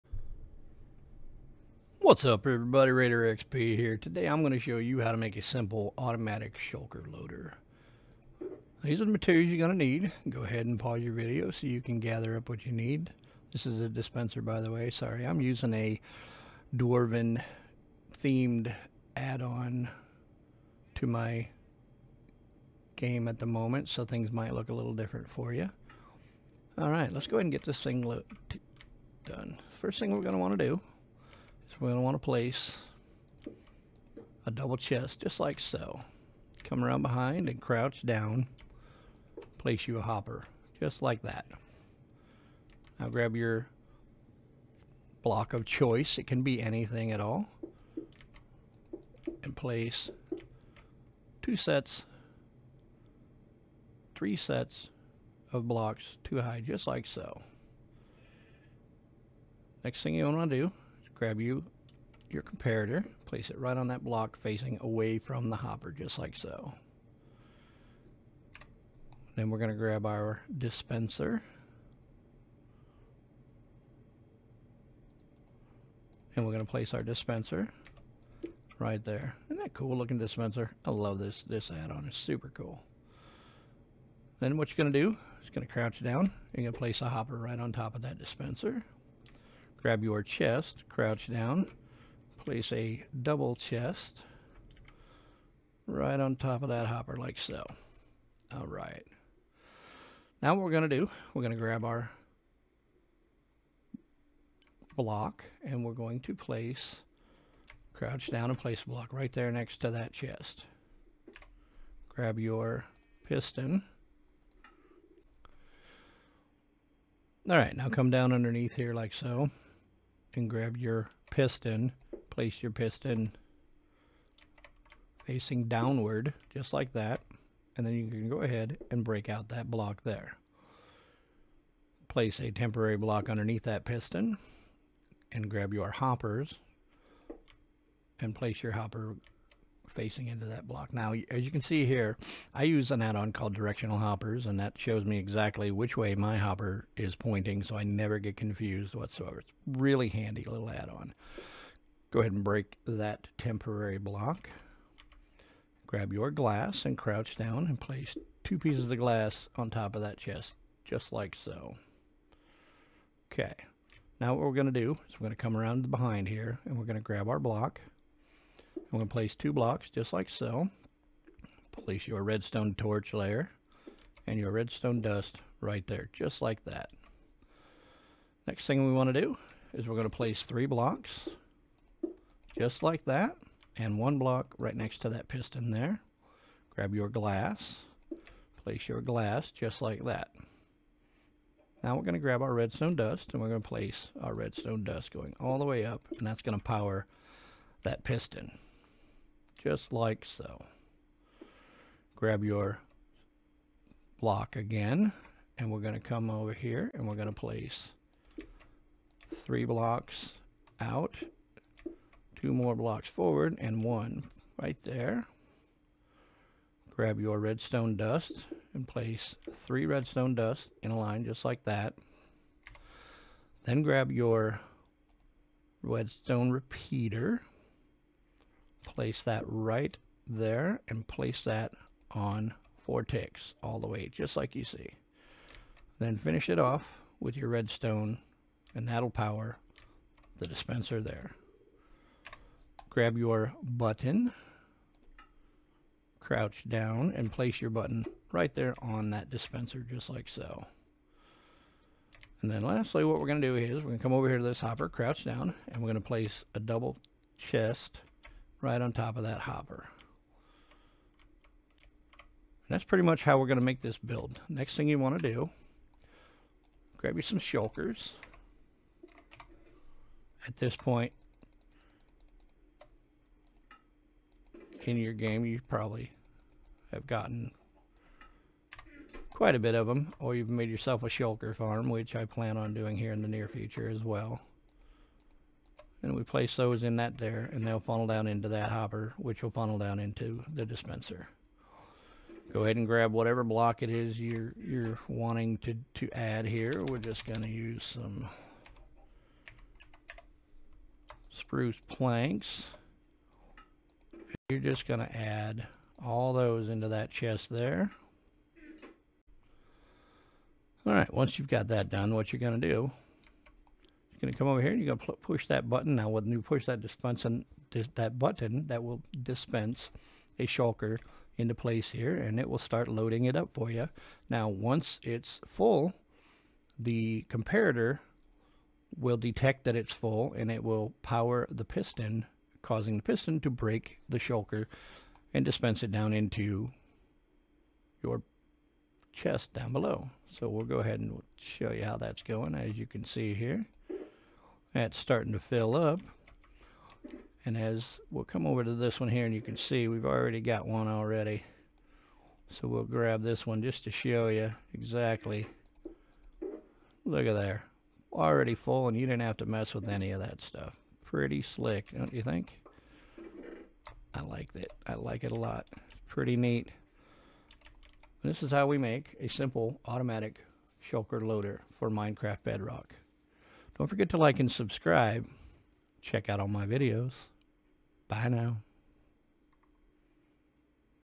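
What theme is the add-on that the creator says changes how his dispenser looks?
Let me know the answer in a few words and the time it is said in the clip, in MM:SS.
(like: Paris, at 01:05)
Dwarven, at 00:16.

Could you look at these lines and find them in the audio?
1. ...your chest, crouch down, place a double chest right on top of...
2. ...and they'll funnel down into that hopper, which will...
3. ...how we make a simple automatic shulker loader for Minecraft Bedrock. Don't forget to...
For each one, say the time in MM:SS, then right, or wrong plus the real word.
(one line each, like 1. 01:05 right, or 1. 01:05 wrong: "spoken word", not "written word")
1. 01:30 right
2. 04:47 right
3. 06:08 right.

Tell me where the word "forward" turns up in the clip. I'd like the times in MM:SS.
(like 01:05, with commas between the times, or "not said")
03:33.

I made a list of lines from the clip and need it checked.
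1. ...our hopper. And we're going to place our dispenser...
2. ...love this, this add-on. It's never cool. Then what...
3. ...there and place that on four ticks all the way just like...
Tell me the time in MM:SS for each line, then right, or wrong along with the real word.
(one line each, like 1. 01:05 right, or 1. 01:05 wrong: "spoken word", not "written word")
1. 01:10 wrong: "dispenser", not "hopper"
2. 01:20 wrong: "super", not "never"
3. 03:50 right.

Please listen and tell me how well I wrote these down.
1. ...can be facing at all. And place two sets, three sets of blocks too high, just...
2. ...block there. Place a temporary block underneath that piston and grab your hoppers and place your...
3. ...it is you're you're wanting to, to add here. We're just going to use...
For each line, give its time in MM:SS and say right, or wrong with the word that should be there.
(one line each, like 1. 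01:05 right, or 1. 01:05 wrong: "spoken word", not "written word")
1. 00:46 wrong: "anything", not "facing"
2. 02:09 right
3. 04:53 right.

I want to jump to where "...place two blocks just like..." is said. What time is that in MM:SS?
02:49.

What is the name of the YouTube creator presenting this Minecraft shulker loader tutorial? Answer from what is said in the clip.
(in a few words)
Raider XP.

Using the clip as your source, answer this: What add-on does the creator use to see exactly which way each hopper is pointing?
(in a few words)
directional hoppers.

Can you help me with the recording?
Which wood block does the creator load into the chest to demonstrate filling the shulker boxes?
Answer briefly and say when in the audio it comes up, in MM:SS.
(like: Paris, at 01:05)
spruce planks, at 05:01.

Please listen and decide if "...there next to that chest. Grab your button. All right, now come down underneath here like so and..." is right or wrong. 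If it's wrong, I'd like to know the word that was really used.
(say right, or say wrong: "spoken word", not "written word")
wrong: "piston", not "button".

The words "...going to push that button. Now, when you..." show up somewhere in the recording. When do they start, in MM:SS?
05:14.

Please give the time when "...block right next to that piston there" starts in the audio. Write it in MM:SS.
03:04.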